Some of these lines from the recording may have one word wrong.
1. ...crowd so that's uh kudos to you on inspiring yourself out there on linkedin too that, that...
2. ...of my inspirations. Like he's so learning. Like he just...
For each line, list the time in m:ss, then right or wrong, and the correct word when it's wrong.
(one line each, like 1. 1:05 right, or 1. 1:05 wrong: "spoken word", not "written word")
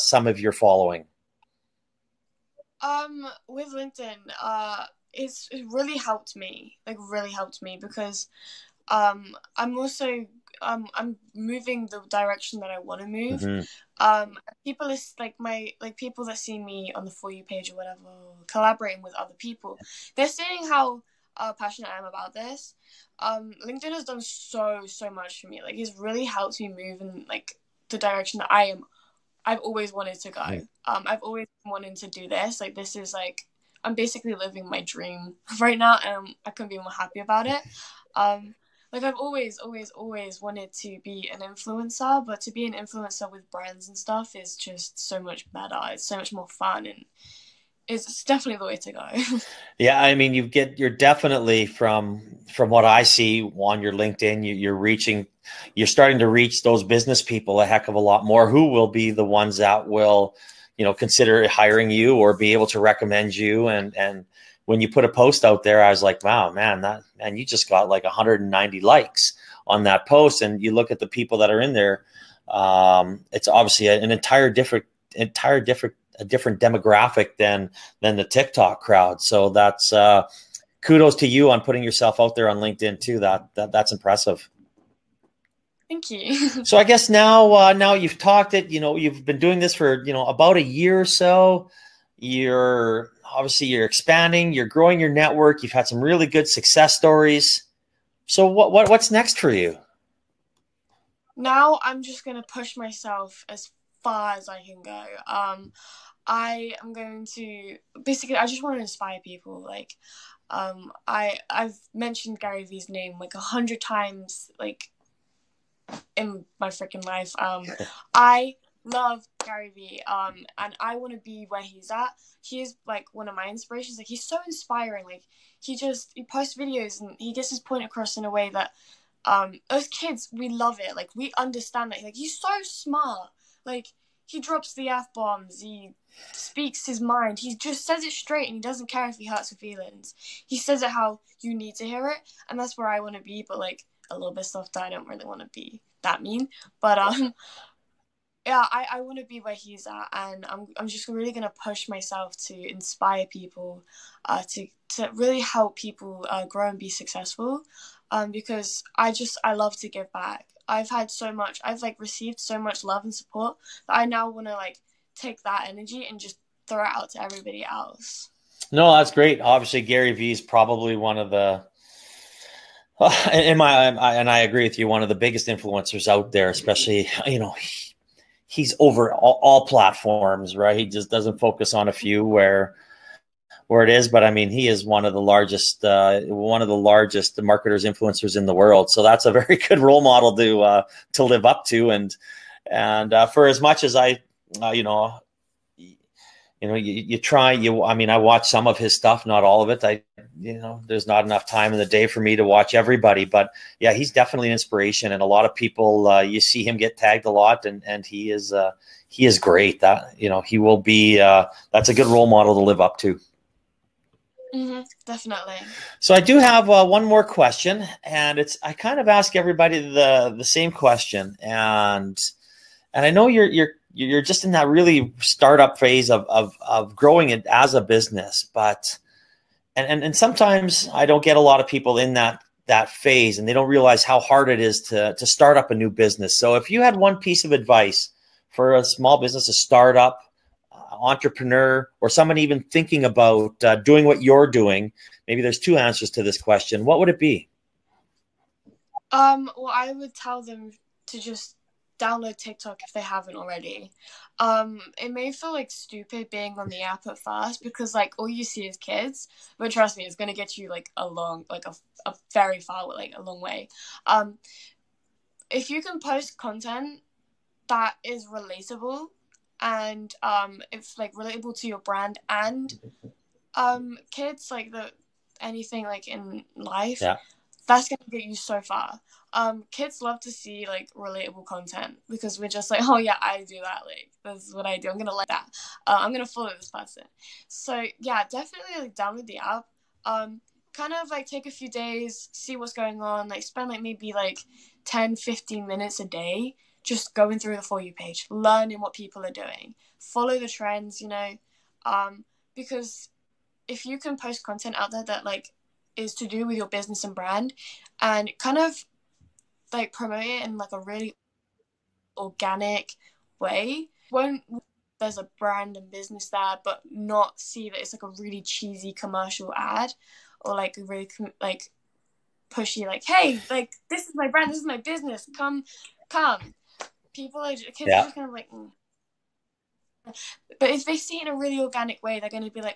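1. 1:18 wrong: "putting", not "inspiring"
2. 2:03 wrong: "inspiring", not "learning".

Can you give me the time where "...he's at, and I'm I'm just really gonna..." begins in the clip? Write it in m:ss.
2:29.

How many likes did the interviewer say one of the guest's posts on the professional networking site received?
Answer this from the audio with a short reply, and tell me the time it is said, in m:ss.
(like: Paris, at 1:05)
190, at 1:08.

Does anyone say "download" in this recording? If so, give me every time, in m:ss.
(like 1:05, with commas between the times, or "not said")
4:11, 4:48.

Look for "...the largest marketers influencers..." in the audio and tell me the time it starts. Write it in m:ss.
3:06.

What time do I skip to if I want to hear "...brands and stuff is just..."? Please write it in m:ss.
0:43.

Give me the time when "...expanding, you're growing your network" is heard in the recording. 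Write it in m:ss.
1:33.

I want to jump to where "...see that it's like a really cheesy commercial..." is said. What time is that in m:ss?
5:17.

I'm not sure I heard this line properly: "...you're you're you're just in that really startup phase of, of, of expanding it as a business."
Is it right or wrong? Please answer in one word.
wrong.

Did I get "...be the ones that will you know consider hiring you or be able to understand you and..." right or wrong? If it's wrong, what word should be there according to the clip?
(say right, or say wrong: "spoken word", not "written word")
wrong: "recommend", not "understand".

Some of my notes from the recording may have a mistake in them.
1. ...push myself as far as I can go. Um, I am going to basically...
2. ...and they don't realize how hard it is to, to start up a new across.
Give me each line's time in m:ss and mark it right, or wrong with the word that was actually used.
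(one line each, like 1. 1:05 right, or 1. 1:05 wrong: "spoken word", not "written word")
1. 1:42 right
2. 3:53 wrong: "business", not "across".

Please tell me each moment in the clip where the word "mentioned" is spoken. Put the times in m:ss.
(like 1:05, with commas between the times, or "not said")
1:51.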